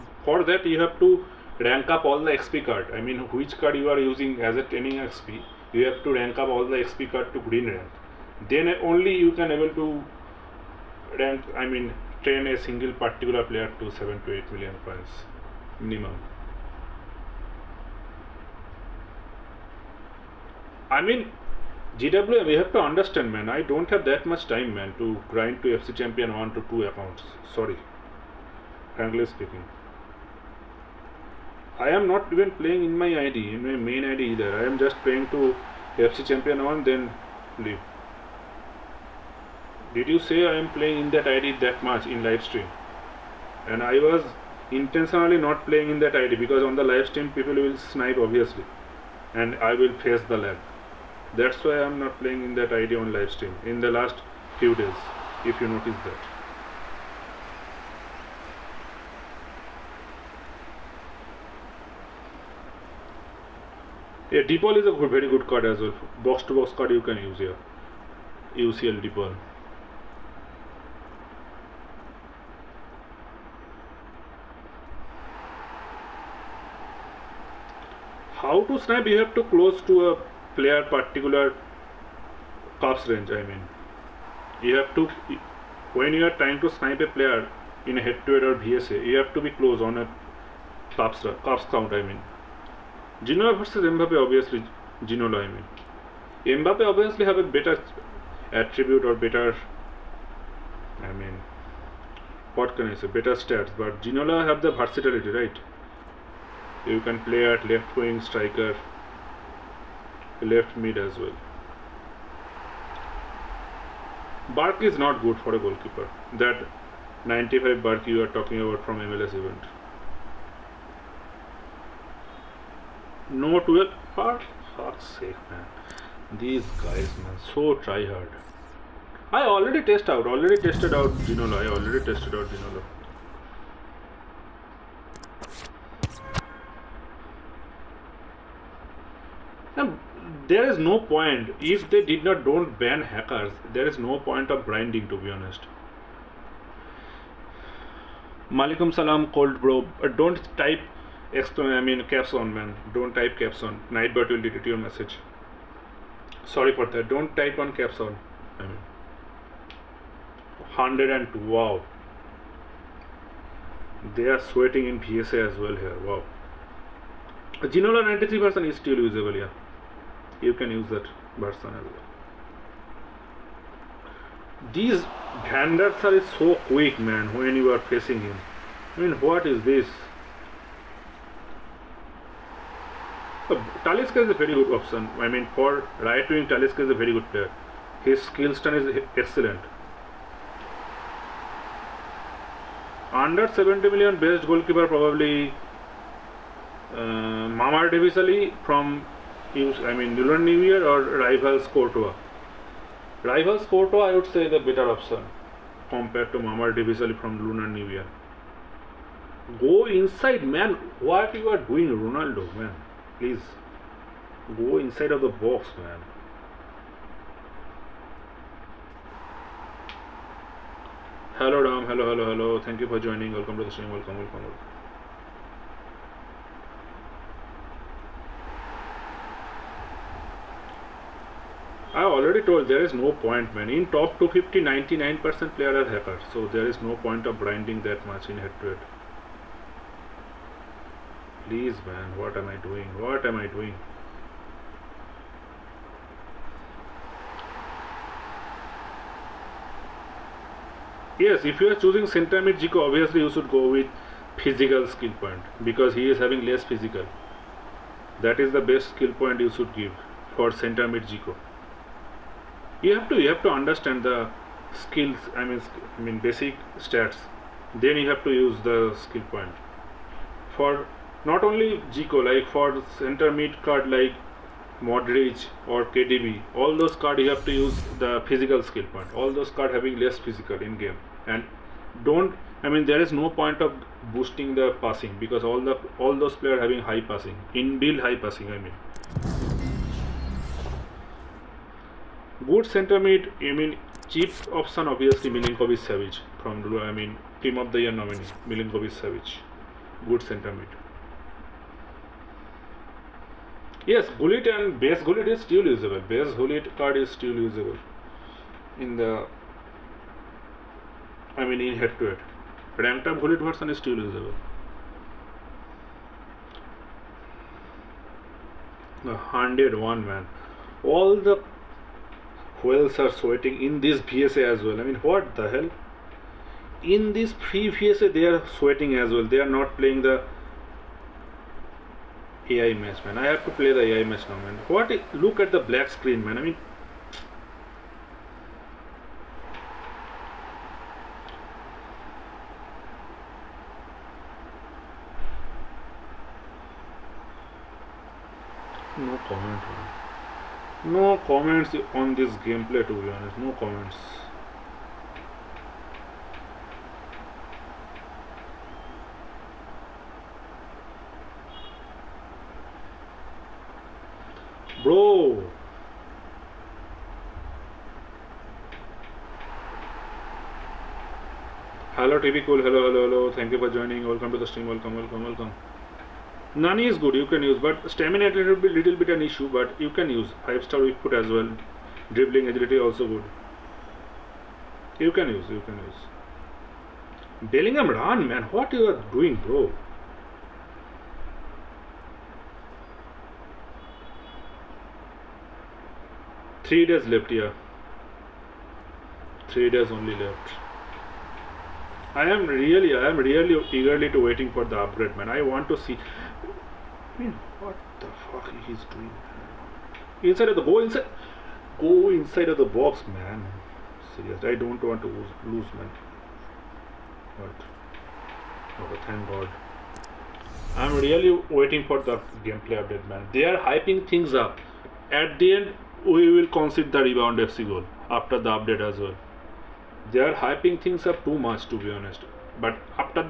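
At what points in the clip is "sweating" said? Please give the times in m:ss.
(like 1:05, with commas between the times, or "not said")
2:44, 5:23, 5:28.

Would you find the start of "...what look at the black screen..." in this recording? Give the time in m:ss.
5:34.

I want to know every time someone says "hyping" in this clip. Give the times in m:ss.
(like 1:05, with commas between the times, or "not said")
7:03, 7:10.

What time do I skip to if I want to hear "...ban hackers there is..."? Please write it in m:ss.
2:22.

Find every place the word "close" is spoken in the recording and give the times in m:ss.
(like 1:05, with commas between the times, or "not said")
1:19, 1:29.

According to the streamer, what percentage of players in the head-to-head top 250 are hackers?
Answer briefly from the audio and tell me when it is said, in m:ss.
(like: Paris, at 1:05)
99%, at 3:54.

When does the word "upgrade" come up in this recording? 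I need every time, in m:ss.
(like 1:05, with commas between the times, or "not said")
6:44.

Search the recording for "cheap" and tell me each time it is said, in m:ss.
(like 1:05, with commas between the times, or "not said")
4:54.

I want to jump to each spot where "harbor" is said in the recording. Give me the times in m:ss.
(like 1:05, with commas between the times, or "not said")
not said.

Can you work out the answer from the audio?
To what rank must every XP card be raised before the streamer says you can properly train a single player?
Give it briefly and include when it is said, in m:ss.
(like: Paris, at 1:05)
Green rank, at 0:07.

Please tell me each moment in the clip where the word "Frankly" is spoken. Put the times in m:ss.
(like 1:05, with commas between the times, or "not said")
0:28.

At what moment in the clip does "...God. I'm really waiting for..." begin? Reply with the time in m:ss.
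6:59.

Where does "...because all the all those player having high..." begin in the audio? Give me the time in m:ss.
4:45.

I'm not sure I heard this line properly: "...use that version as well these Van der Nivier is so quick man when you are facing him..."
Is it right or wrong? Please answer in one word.
wrong.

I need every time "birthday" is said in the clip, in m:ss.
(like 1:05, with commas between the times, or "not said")
not said.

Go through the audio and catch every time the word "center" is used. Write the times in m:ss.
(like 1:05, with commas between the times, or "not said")
4:12, 4:20, 4:32, 4:52, 5:00.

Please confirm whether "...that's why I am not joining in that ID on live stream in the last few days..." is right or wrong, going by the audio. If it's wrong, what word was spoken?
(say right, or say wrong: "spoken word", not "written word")
wrong: "playing", not "joining".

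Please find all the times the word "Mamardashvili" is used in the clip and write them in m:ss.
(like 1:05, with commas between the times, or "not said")
3:17, 3:26.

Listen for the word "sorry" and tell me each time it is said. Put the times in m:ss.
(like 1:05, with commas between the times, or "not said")
0:27, 2:36.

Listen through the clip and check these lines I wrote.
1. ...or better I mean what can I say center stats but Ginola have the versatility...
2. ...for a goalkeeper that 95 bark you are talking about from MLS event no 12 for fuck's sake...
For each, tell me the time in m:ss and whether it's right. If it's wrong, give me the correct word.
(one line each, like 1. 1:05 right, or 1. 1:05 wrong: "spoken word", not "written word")
1. 1:39 wrong: "better", not "center"
2. 1:55 right.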